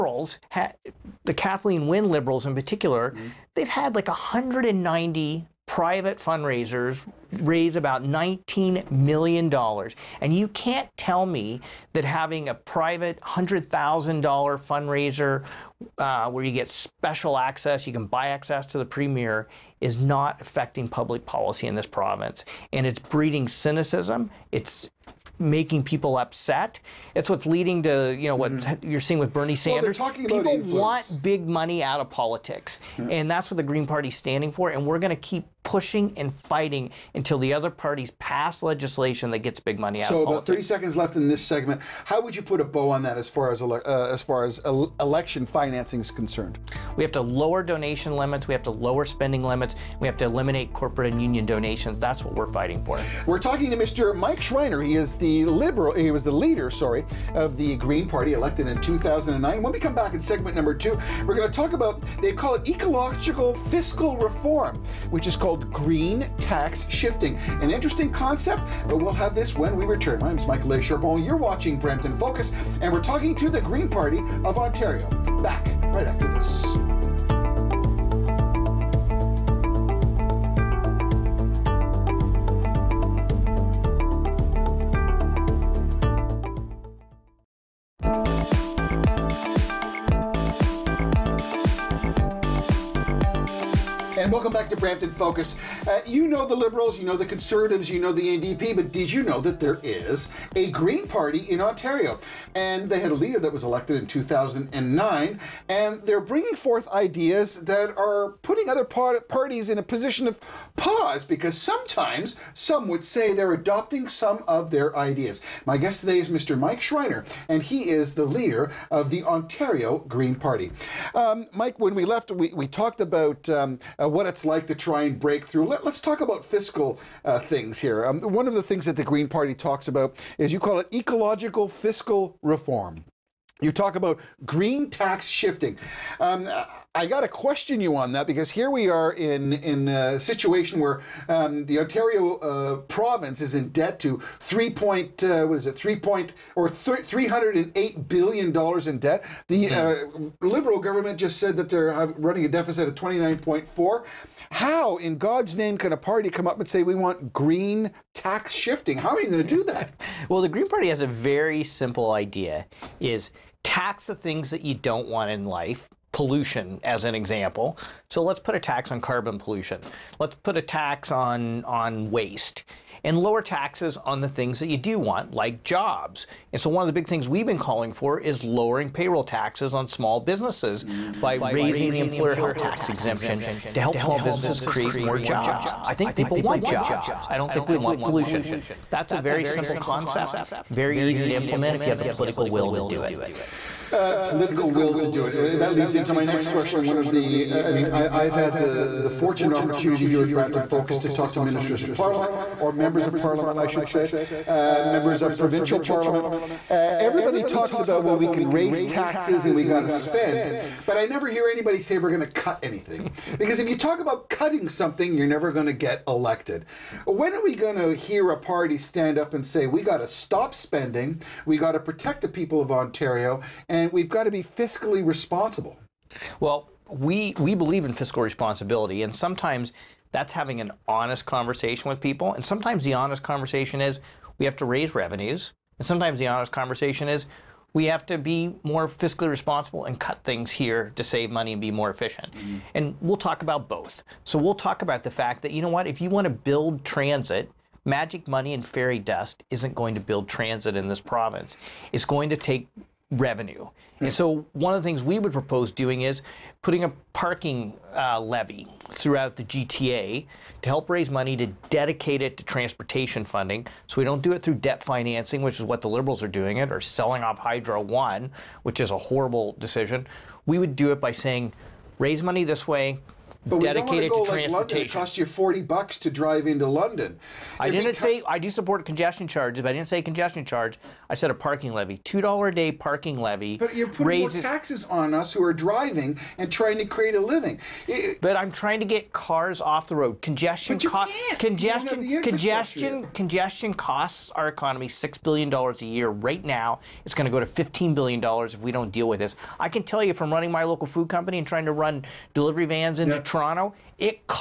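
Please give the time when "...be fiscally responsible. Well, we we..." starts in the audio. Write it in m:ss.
3:44.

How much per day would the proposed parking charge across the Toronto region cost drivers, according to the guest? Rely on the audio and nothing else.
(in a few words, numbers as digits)
$2.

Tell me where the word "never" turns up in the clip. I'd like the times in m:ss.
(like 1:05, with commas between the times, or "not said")
3:31, 3:35.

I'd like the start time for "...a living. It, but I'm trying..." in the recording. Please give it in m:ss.
4:47.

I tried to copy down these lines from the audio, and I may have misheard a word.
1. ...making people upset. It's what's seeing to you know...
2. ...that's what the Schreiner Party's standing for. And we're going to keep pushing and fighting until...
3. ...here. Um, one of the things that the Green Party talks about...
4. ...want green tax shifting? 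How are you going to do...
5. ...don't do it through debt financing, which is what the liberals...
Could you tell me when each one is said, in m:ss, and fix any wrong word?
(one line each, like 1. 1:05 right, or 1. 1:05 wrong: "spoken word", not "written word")
1. 0:25 wrong: "leading", not "seeing"
2. 0:33 wrong: "Green", not "Schreiner"
3. 2:07 right
4. 2:36 right
5. 4:24 right.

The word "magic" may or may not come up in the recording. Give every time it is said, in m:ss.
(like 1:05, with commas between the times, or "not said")
4:07.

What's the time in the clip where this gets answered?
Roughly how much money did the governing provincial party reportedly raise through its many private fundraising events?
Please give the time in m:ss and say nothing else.
0:08.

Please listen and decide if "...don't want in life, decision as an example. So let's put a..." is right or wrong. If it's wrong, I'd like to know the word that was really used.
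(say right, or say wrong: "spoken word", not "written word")
wrong: "pollution", not "decision".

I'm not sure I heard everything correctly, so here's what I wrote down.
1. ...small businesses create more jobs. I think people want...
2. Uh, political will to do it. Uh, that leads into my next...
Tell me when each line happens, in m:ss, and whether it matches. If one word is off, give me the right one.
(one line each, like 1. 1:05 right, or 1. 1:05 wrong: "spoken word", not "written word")
1. 3:04 right
2. 3:13 right.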